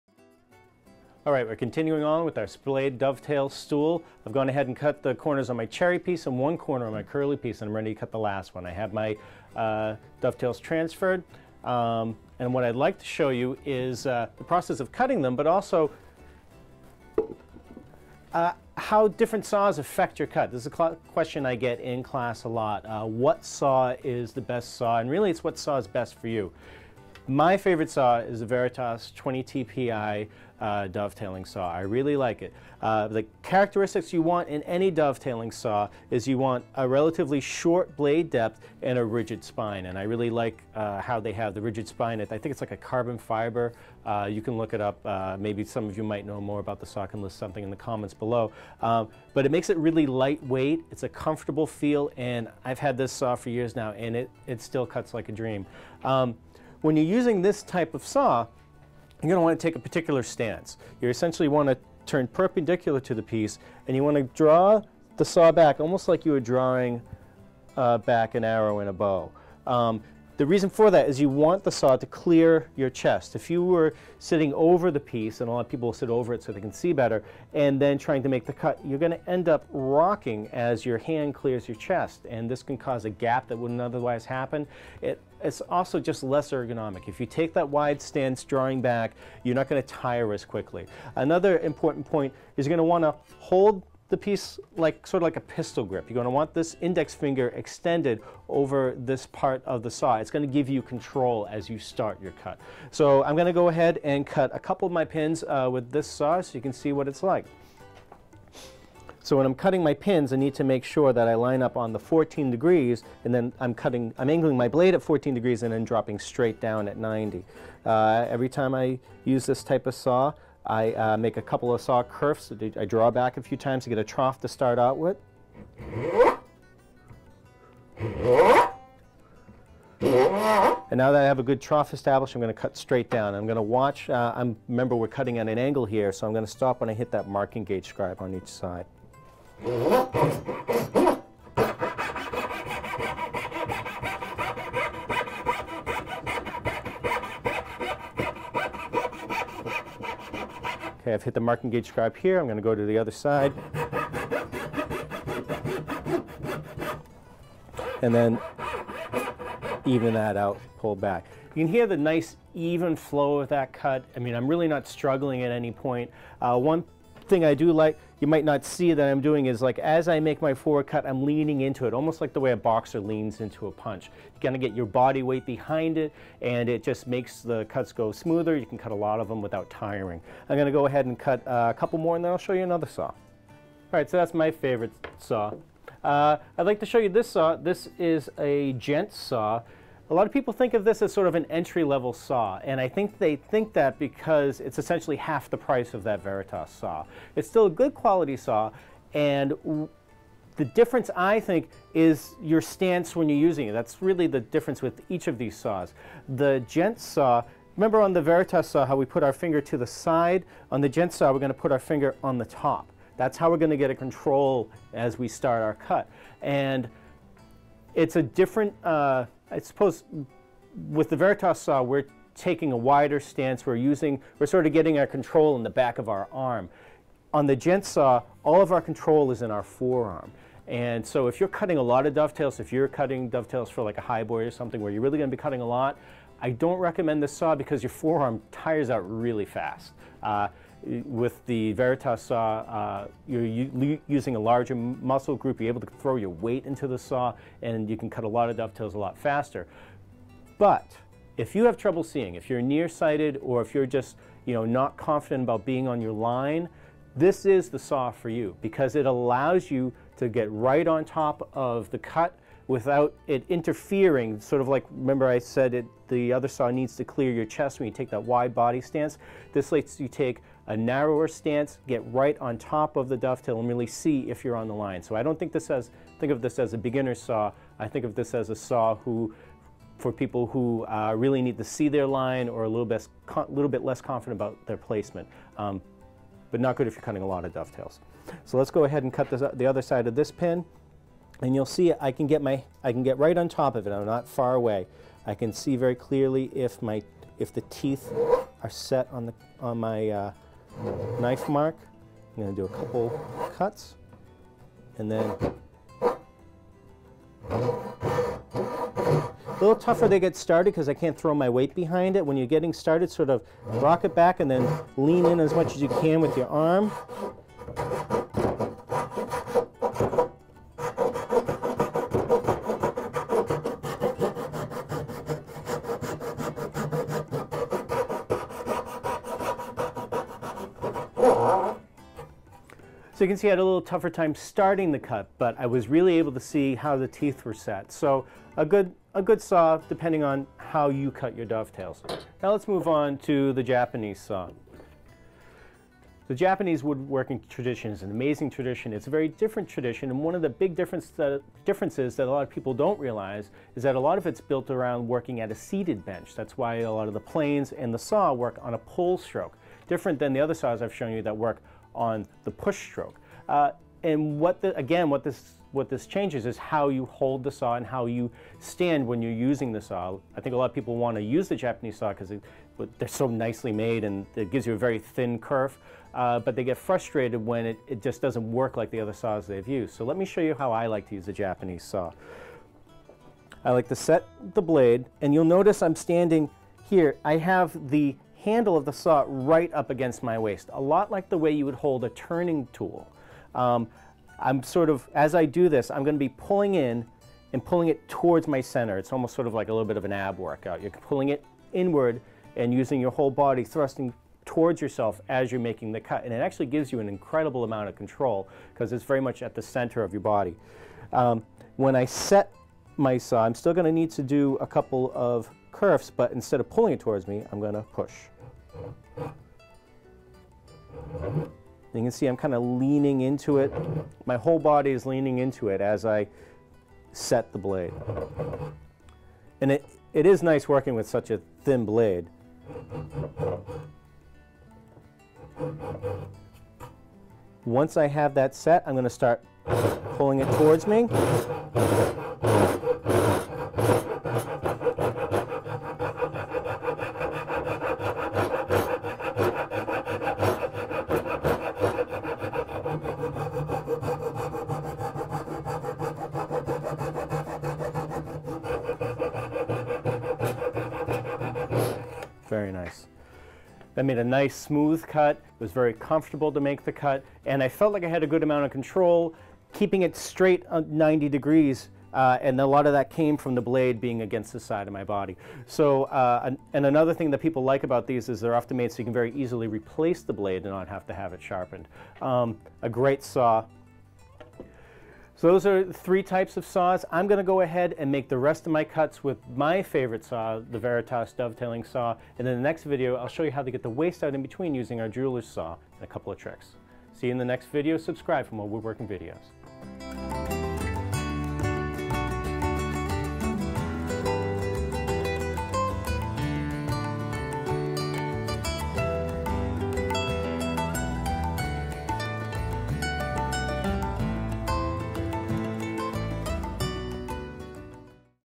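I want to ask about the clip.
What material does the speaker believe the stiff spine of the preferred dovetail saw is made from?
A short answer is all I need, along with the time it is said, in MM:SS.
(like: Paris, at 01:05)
carbon fiber, at 00:42.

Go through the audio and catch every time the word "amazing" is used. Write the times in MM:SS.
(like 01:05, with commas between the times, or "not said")
05:48.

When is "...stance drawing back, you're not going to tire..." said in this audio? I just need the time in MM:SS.
01:28.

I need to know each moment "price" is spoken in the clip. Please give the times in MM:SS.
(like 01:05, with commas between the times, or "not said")
03:15.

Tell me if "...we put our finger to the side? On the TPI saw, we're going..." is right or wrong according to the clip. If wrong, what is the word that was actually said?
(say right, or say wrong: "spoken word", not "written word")
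wrong: "Gent", not "TPI".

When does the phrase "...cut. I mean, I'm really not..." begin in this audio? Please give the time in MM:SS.
02:43.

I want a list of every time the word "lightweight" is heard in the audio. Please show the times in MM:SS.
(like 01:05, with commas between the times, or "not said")
00:50.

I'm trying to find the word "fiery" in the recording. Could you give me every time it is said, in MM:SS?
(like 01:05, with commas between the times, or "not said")
not said.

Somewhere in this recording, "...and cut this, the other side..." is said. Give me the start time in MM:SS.
04:49.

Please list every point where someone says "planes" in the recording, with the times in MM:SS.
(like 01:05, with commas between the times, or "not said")
05:57.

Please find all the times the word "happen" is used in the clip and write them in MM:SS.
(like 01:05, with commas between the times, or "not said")
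01:24.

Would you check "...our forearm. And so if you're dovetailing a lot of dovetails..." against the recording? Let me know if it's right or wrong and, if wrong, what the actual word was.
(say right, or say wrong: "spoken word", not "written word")
wrong: "cutting", not "dovetailing".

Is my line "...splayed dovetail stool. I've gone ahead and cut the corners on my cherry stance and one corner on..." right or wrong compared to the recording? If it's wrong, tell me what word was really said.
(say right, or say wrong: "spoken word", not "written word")
wrong: "piece", not "stance".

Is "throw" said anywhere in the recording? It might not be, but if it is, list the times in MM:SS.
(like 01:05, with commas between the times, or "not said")
04:05, 05:11.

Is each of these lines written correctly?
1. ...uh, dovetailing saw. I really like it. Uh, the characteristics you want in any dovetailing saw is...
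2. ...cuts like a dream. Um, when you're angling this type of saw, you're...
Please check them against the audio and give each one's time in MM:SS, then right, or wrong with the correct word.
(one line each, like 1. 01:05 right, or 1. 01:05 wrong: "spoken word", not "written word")
1. 00:30 right
2. 00:54 wrong: "using", not "angling".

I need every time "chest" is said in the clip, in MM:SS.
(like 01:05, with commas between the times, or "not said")
01:12, 01:21, 04:27.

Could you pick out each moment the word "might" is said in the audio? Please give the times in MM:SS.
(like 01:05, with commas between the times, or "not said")
00:46, 02:48.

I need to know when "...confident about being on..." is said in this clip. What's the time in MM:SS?
04:14.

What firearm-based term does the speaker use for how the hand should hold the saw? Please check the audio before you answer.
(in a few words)
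pistol grip.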